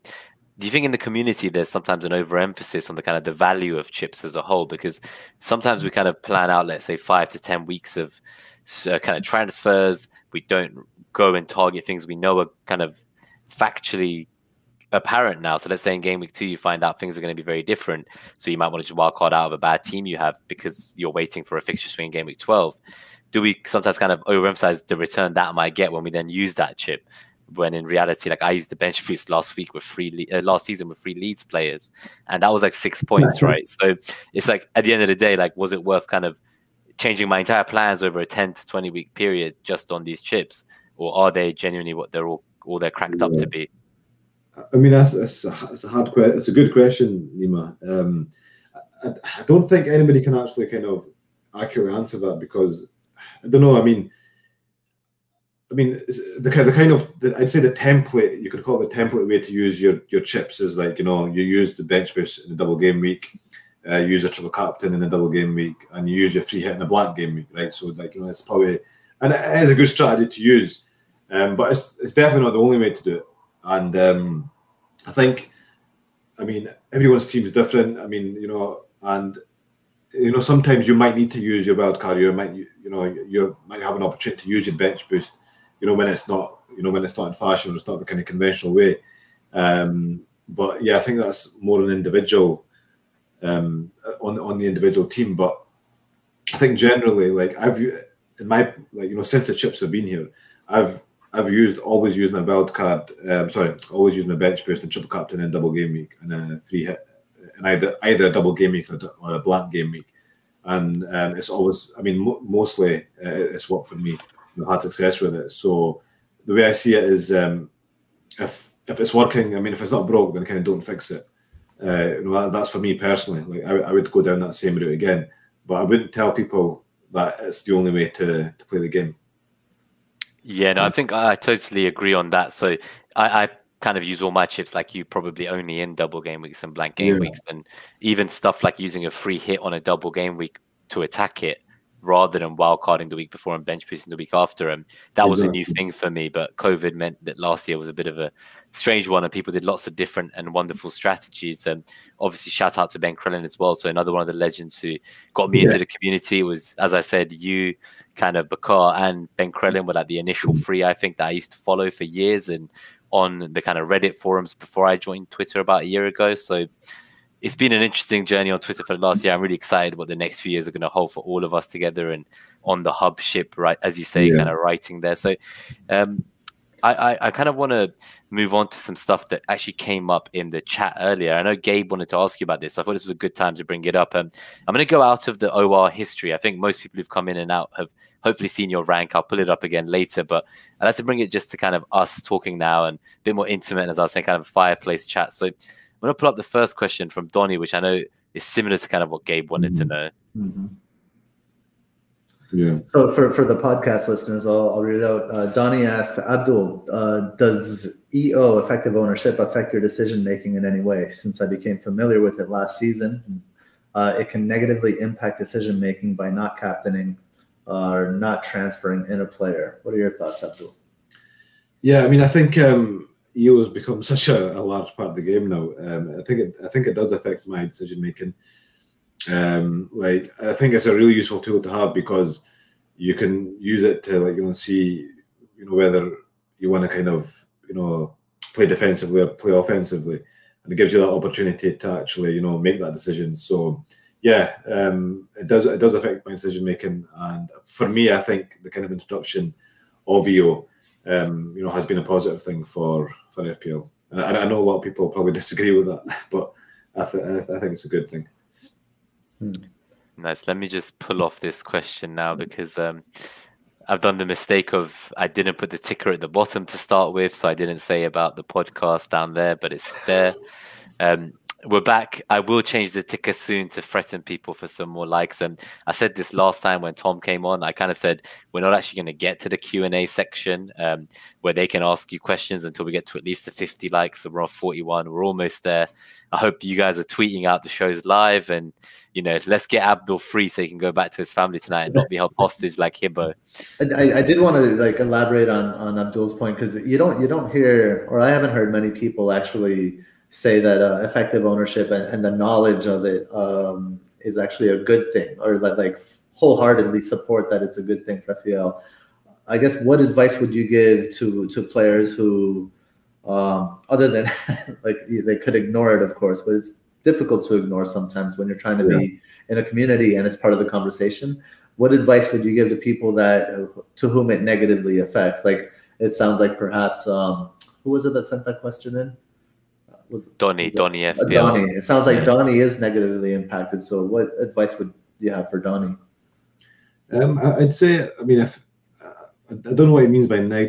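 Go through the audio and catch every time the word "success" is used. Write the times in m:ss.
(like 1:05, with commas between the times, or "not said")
1:54.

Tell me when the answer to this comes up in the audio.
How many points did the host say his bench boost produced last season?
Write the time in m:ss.
0:32.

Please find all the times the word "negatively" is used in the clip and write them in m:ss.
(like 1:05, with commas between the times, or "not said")
3:34, 5:24, 5:32.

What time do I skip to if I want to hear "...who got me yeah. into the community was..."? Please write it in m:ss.
2:34.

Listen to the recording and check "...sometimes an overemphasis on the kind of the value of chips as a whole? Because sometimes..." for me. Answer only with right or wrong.
right.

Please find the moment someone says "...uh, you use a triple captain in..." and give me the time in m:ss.
1:03.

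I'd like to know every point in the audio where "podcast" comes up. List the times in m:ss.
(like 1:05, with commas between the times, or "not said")
3:23, 4:28.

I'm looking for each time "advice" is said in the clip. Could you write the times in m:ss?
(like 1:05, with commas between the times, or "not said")
5:09, 5:21, 5:34.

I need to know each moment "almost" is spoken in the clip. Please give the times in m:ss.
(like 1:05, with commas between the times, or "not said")
4:45.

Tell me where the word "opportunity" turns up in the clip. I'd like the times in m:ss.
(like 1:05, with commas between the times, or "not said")
1:24, 4:01.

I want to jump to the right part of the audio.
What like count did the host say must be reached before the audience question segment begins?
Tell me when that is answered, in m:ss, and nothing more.
4:43.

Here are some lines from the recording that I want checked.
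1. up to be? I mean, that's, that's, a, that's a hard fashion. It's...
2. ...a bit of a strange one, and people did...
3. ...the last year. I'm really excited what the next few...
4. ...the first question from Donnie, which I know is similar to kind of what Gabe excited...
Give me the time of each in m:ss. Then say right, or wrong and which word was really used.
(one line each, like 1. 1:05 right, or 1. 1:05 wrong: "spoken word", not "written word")
1. 0:43 wrong: "question", not "fashion"
2. 2:27 right
3. 2:48 right
4. 3:16 wrong: "wanted", not "excited".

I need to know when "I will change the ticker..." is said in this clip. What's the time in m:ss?
4:32.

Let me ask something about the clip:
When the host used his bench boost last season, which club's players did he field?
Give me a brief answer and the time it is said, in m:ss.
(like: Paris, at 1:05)
Leeds, at 0:31.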